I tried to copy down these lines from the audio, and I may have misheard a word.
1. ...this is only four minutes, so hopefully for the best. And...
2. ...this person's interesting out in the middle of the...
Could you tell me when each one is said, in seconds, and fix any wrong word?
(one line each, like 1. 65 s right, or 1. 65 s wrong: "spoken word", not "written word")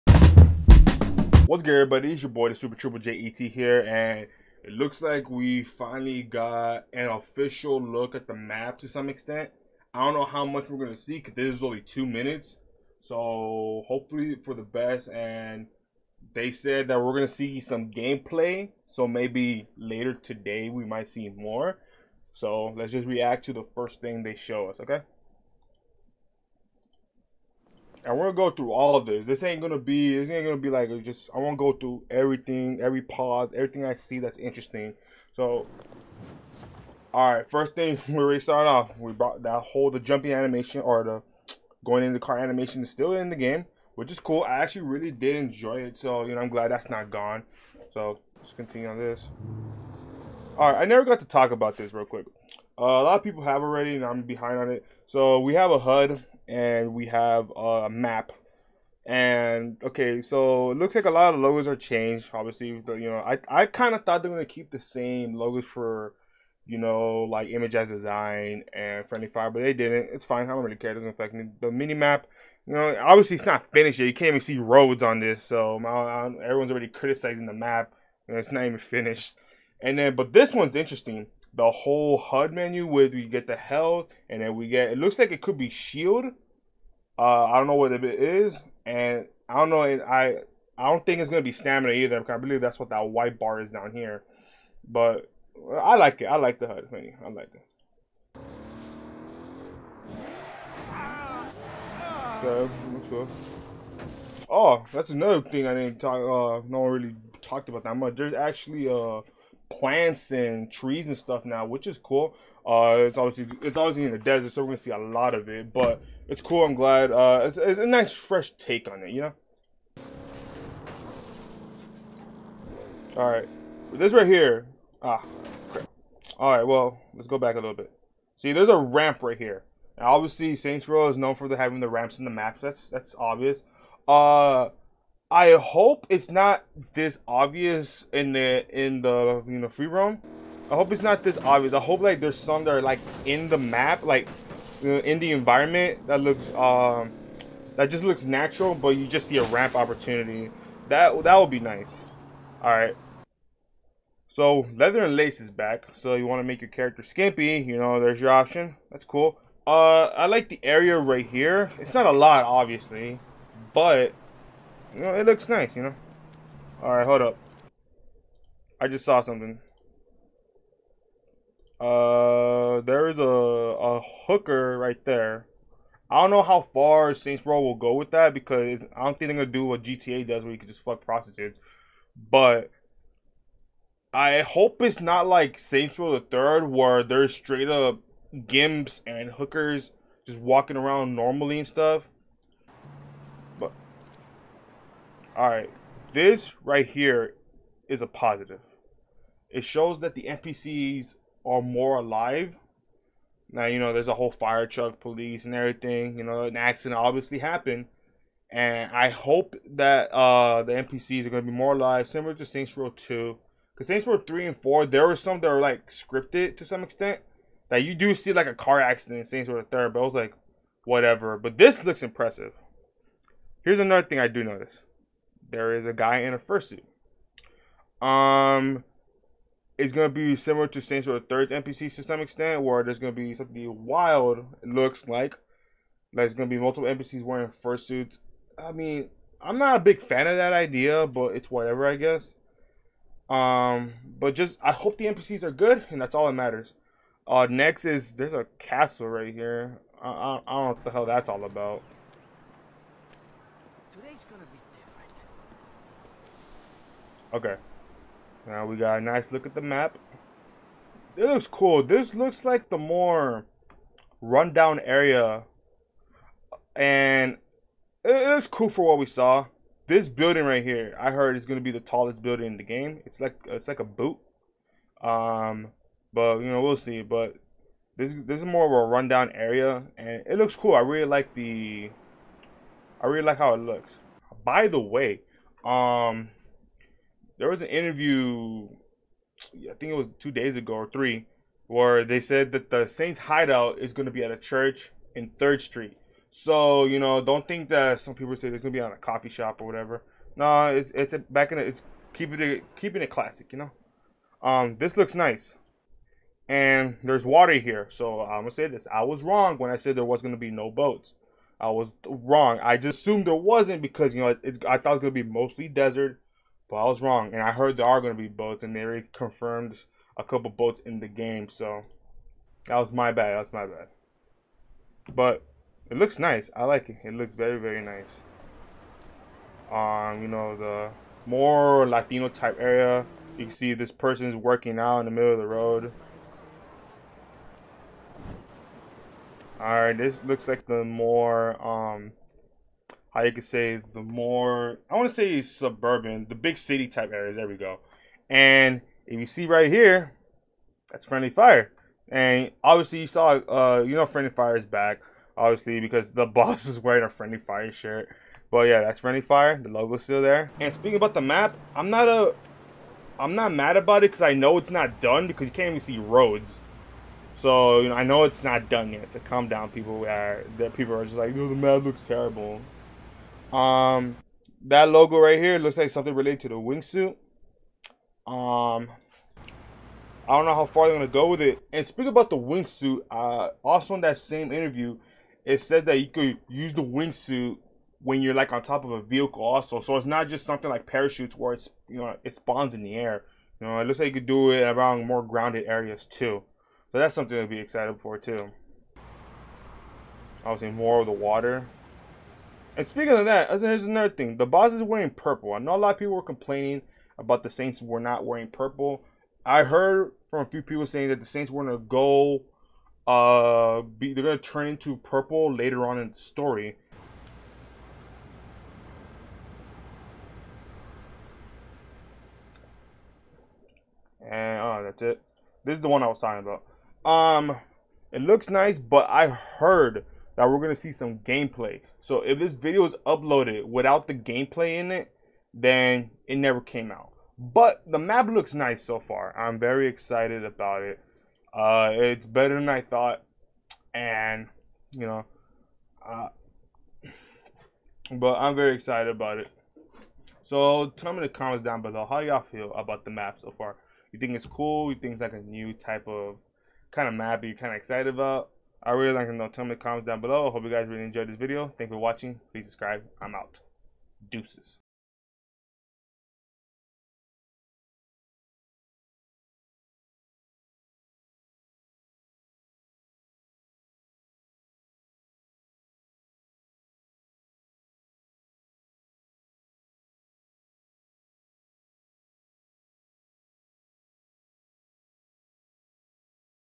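1. 11 s wrong: "two", not "four"
2. 333 s wrong: "working", not "interesting".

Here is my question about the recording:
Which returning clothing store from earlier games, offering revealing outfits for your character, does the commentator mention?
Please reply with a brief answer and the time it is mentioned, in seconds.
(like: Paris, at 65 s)
Leather and Lace, at 154 s.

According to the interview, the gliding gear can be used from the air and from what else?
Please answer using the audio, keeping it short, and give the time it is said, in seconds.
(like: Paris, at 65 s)
A vehicle, at 389 s.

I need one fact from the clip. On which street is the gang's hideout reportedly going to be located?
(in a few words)
Third Street.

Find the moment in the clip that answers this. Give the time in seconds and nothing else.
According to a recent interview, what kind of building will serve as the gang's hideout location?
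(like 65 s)
294 s.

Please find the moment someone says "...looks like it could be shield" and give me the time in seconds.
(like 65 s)
84 s.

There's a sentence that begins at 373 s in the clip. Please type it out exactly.
Um, that logo right here looks like something related to the wingsuit.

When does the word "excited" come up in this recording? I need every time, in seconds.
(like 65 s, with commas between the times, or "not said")
397 s, 439 s, 448 s, 457 s.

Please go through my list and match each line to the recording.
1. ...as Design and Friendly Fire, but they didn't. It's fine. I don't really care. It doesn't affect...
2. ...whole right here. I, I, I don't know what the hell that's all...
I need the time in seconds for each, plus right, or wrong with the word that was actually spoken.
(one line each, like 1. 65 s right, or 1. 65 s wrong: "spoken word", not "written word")
1. 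67 s right
2. 248 s wrong: "castle", not "whole".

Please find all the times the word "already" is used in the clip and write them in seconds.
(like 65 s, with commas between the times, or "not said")
38 s, 53 s, 76 s.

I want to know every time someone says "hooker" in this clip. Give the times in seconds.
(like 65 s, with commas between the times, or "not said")
174 s, 189 s.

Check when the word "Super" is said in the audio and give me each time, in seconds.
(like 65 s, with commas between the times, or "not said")
2 s.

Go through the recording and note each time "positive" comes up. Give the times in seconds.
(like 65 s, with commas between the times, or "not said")
198 s.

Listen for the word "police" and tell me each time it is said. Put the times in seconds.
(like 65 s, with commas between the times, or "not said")
204 s.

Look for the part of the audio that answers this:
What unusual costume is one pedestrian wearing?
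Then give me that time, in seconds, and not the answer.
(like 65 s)
226 s.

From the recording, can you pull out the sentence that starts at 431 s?
So if this video is uploaded without the gameplay in it, then it never came out.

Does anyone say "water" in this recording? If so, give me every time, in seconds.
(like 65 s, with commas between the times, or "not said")
307 s, 401 s.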